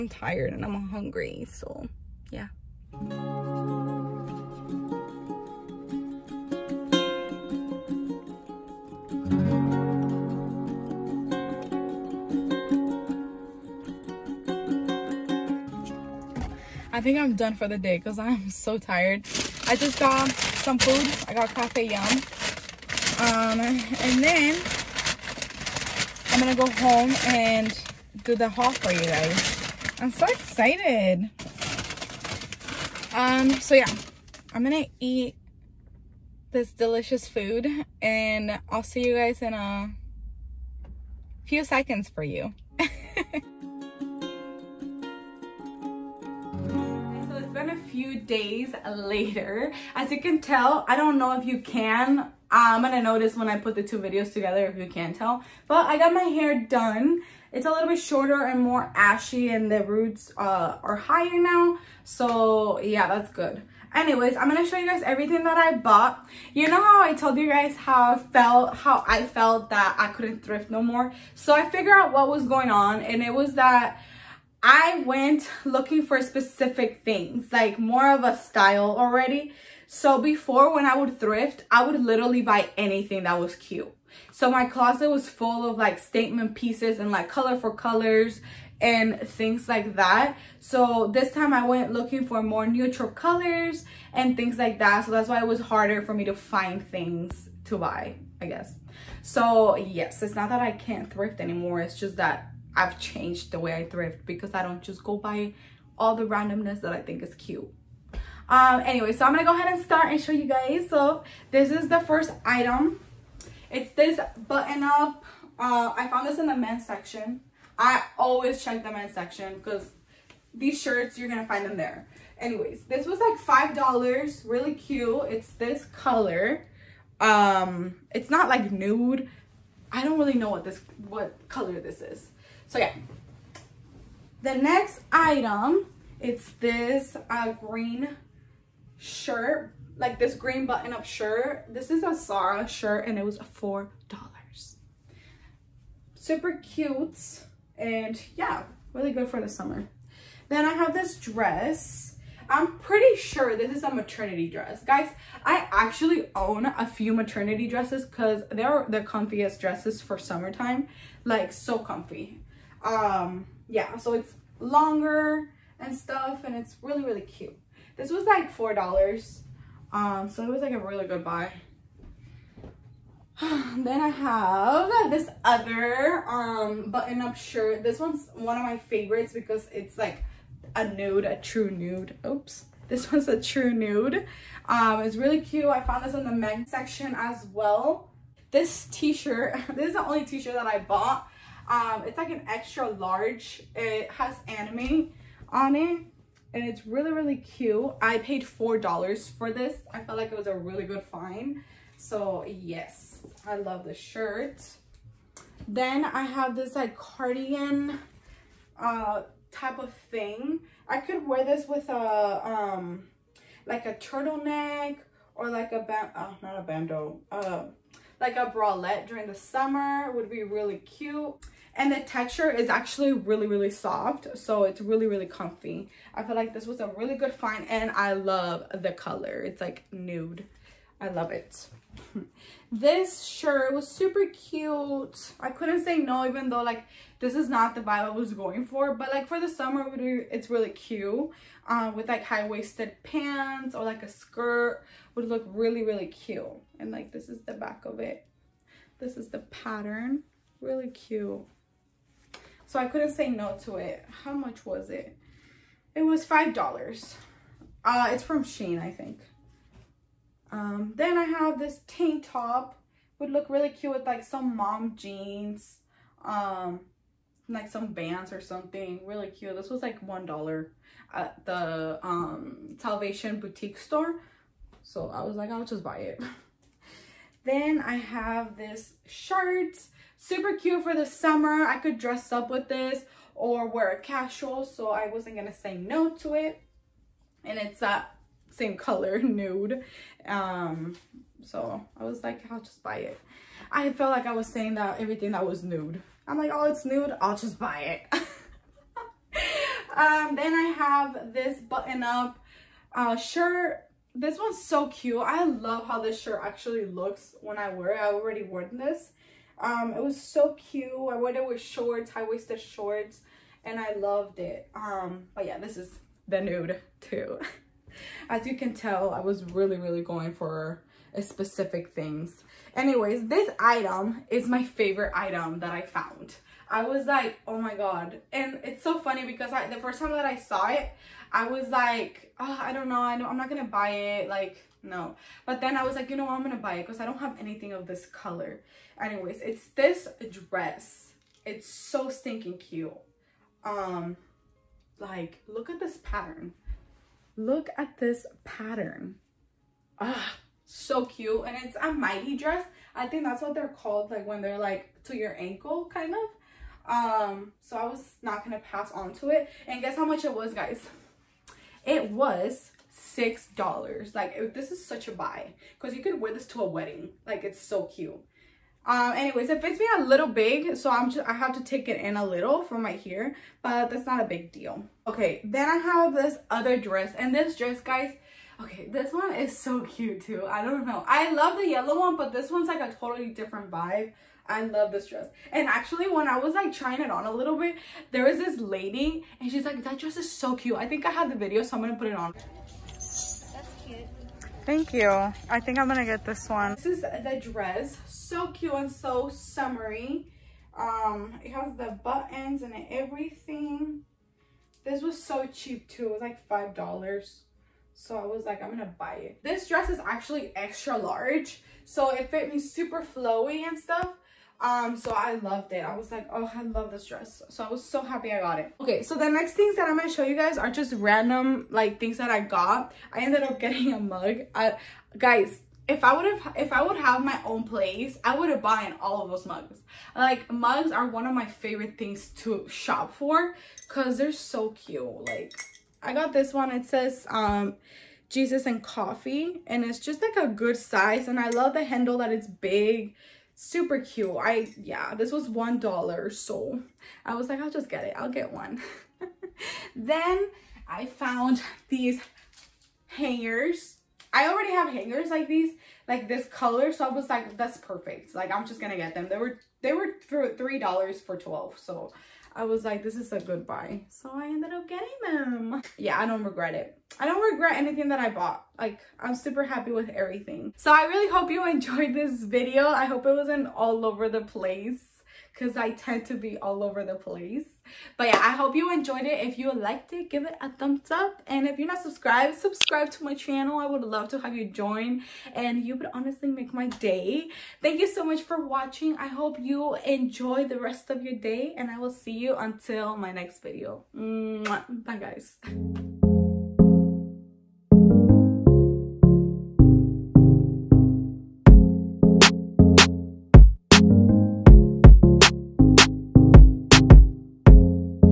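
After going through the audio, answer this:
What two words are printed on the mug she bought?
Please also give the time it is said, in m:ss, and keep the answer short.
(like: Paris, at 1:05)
Jesus and coffee, at 7:18.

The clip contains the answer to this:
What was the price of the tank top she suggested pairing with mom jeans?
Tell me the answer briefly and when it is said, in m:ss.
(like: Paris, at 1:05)
$1, at 4:30.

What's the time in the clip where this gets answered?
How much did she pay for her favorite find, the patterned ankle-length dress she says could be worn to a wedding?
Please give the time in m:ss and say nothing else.
6:02.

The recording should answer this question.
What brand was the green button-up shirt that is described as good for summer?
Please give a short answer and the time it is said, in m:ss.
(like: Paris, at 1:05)
Zara, at 2:22.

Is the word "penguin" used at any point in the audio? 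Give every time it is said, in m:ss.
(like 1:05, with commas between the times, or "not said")
not said.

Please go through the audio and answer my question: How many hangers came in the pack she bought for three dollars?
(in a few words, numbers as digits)
12.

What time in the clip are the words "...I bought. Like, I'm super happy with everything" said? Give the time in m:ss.
7:48.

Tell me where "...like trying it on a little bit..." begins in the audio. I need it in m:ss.
6:26.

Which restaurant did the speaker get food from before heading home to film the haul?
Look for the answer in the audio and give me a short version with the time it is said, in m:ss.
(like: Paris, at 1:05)
Cafe Yum, at 0:21.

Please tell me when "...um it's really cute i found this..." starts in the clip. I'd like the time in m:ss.
3:04.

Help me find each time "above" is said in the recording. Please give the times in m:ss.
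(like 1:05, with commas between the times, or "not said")
not said.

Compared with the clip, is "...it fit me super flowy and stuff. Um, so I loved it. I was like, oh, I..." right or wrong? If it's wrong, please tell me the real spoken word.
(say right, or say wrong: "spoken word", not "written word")
right.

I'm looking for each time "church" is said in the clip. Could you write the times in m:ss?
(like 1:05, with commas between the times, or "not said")
not said.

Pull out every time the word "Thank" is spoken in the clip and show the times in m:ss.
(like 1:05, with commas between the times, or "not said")
6:34, 8:07.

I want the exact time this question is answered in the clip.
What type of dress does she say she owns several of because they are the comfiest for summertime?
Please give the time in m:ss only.
2:37.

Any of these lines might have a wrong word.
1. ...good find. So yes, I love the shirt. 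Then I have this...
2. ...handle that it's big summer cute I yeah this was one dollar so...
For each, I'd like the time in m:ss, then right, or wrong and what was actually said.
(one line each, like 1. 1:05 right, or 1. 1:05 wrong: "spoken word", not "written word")
1. 3:20 right
2. 7:21 wrong: "super", not "summer".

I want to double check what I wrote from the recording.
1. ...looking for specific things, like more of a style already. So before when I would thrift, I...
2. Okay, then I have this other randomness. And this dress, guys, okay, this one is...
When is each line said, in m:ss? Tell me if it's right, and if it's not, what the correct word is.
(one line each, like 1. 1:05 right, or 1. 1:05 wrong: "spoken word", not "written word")
1. 1:15 right
2. 6:15 wrong: "dress", not "randomness".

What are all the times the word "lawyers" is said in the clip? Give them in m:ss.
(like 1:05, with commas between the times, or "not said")
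not said.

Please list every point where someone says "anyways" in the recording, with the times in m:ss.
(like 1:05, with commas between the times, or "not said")
1:03, 1:48, 2:02, 5:22, 5:38, 6:09.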